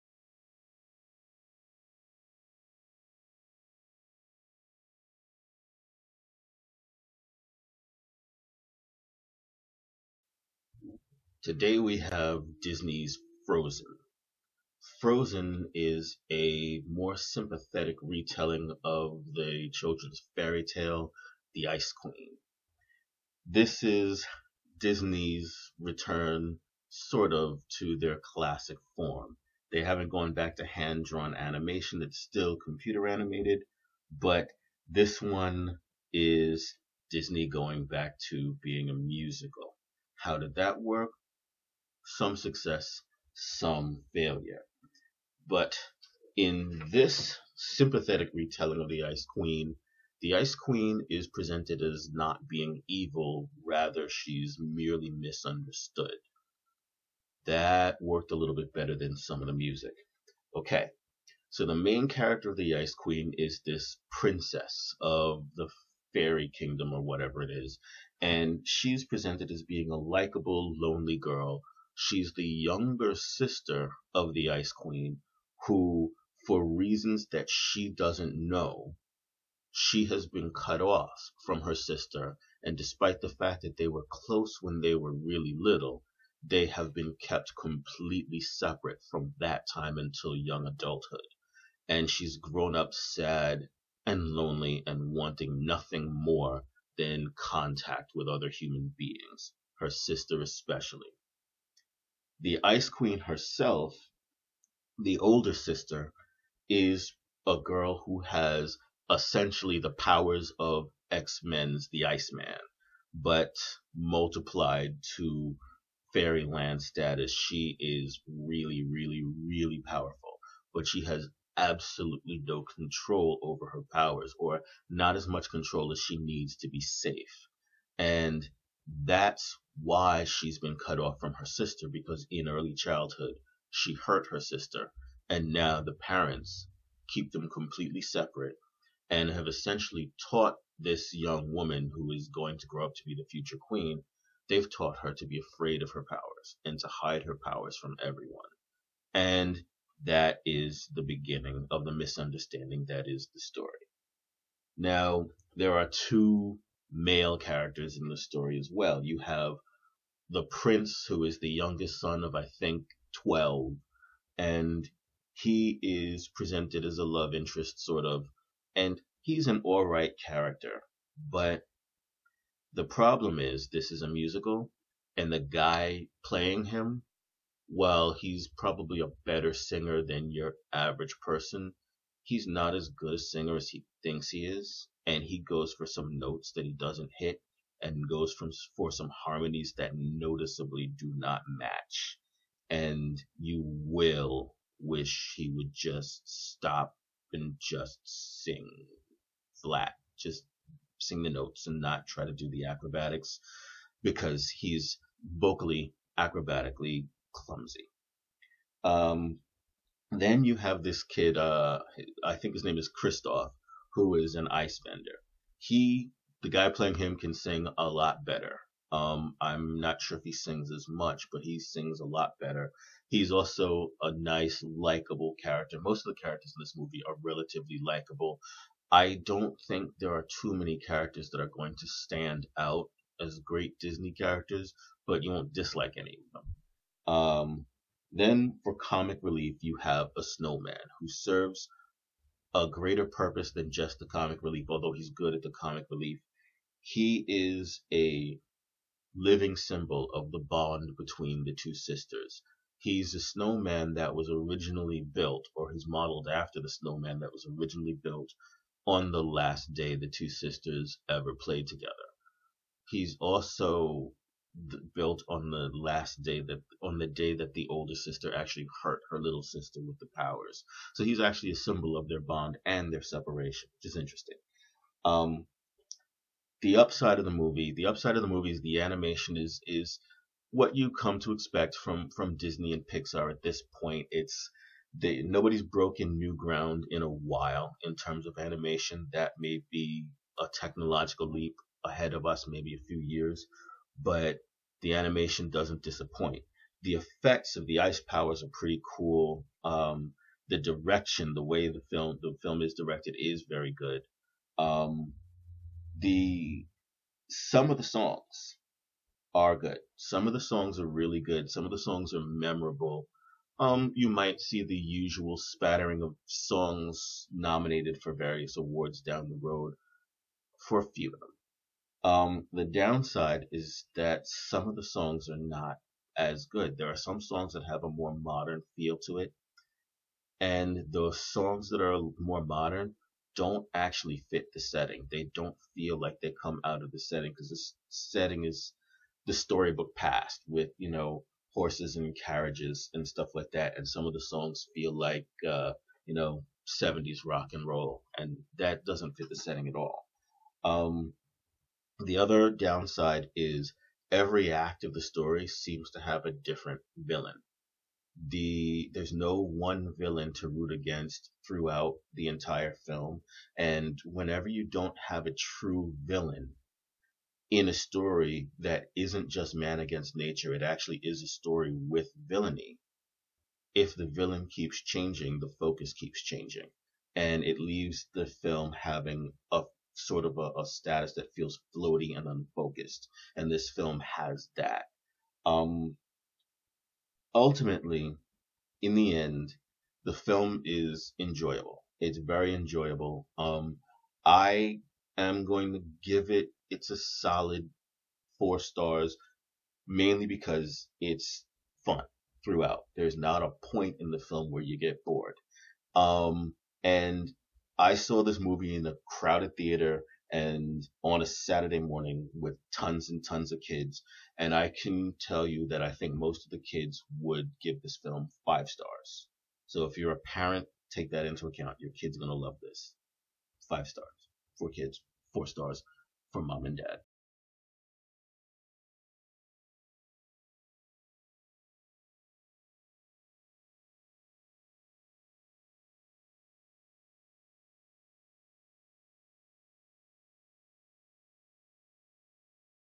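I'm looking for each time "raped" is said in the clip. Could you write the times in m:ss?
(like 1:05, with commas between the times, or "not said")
not said.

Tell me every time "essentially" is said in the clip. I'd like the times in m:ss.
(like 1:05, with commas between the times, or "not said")
1:49, 2:19.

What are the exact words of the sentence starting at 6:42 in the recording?
There's not a point in the film where you get bored.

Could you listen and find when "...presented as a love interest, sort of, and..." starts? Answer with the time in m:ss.
2:46.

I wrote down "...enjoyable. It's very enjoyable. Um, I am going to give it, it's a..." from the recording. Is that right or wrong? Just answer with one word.
right.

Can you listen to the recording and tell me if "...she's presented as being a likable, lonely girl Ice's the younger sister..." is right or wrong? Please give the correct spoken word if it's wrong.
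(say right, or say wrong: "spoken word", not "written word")
wrong: "She", not "Ice".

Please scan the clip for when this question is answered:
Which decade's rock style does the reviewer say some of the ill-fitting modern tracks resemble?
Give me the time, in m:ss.
5:46.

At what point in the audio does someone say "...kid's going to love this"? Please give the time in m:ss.
7:01.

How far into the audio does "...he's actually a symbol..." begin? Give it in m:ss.
4:31.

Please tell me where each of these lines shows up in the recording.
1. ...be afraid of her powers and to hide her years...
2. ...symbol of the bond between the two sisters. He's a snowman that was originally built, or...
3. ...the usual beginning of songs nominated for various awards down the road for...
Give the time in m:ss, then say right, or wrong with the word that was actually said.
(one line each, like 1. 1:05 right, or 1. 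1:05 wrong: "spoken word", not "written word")
1. 2:25 wrong: "powers", not "years"
2. 4:09 right
3. 5:14 wrong: "spattering", not "beginning".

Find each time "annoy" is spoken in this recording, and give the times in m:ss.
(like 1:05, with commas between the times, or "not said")
not said.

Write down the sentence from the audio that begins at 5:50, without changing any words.
Um, the other downside is every act of the story seems to have a different villain.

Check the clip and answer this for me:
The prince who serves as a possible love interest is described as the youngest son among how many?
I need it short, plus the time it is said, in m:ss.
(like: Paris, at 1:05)
12, at 2:43.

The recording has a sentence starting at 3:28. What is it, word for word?
Um, then you have this kid, uh, I think his name is Kristoff, who is an ice vendor.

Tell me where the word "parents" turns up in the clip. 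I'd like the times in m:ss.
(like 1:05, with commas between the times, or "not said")
2:15, 7:00.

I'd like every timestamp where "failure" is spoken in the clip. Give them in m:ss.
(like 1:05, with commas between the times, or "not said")
0:44.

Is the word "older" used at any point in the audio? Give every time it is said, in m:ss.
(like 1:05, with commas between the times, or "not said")
1:45, 4:27.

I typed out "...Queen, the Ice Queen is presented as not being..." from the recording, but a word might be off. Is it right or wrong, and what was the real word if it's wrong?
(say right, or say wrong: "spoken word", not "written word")
right.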